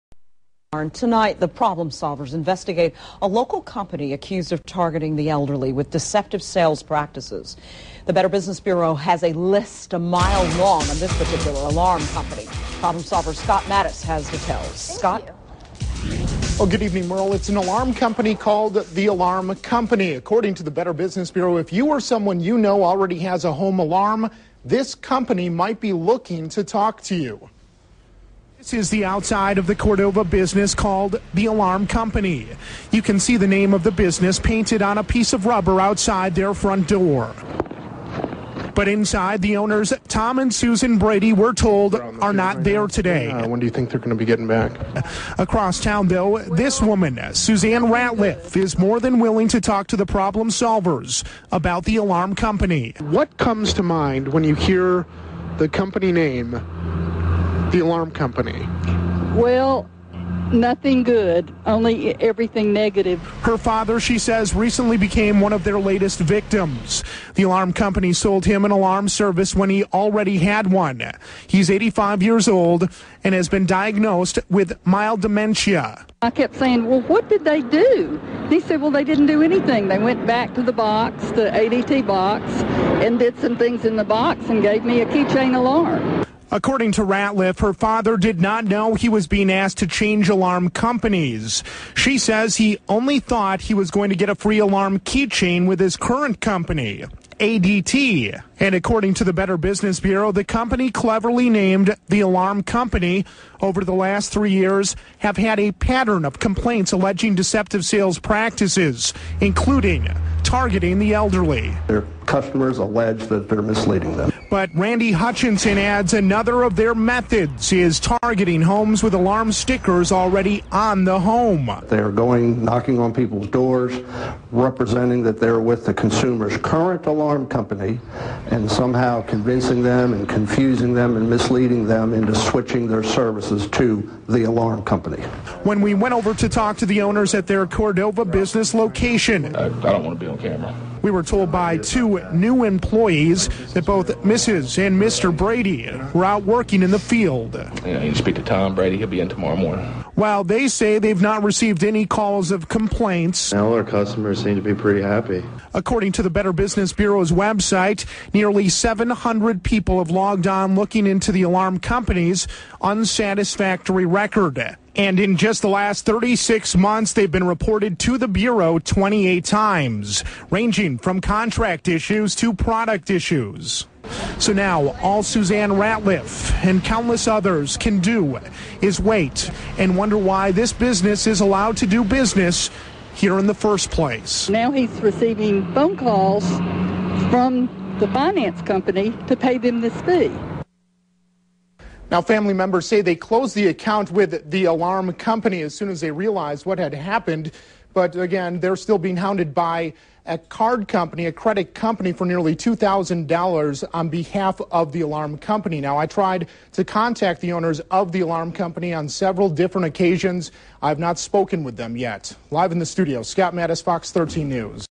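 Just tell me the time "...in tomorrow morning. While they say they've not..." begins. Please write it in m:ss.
2:29.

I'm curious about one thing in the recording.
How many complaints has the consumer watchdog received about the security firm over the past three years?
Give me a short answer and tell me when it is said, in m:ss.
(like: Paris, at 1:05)
28, at 2:48.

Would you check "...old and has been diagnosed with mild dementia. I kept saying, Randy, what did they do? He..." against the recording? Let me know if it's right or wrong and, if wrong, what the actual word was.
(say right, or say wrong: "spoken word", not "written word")
wrong: "Well", not "Randy".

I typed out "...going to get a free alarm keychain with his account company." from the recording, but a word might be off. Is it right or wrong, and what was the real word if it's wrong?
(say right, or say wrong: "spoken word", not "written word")
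wrong: "current", not "account".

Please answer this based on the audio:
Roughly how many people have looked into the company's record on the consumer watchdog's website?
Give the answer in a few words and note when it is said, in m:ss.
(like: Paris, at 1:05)
700, at 2:38.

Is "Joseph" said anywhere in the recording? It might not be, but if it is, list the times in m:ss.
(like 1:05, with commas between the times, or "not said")
not said.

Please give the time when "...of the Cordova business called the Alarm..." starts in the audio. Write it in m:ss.
0:29.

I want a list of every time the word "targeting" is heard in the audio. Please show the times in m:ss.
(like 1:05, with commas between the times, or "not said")
0:04, 1:50, 1:58.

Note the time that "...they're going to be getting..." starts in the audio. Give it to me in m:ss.
0:43.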